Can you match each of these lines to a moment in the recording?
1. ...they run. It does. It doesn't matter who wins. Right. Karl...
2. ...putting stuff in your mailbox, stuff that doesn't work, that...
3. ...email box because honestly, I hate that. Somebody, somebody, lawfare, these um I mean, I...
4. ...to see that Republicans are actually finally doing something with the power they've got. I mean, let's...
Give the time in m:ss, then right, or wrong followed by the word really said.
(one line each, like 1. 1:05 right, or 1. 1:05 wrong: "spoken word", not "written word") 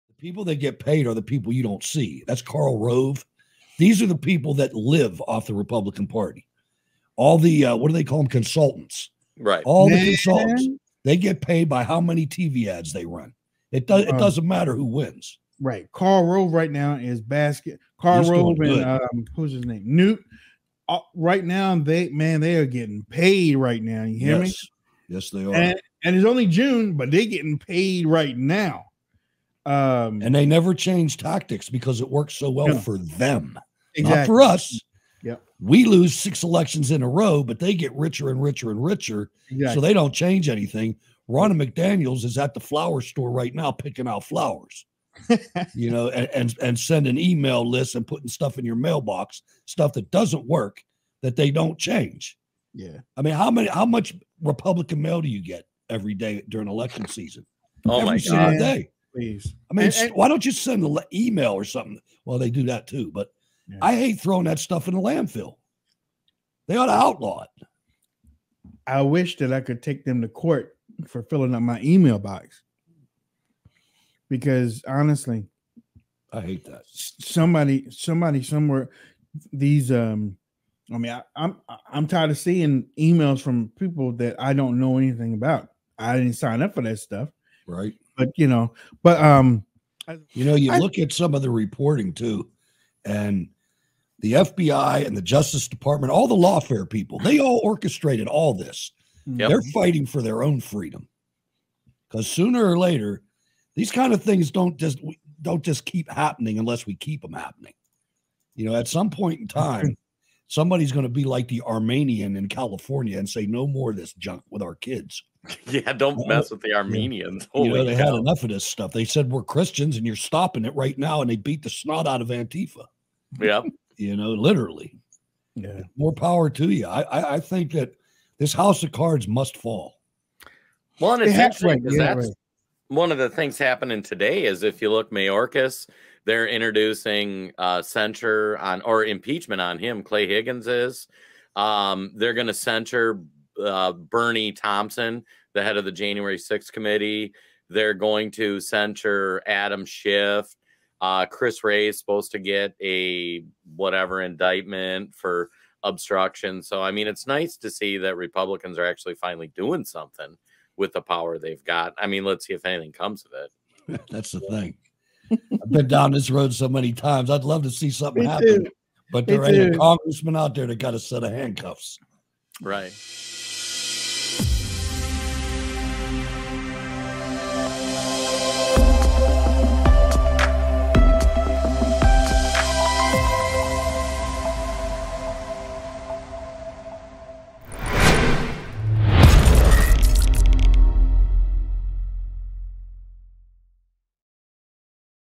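1. 0:12 right
2. 0:48 right
3. 1:11 wrong: "somewhere", not "lawfare"
4. 2:37 right.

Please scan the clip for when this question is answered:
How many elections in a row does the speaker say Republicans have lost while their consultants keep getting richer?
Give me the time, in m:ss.
0:36.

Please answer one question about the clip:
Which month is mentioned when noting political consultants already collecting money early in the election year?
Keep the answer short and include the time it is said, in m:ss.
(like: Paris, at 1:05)
June, at 0:26.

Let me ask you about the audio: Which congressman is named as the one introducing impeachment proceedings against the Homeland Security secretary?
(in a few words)
Clay Higgins.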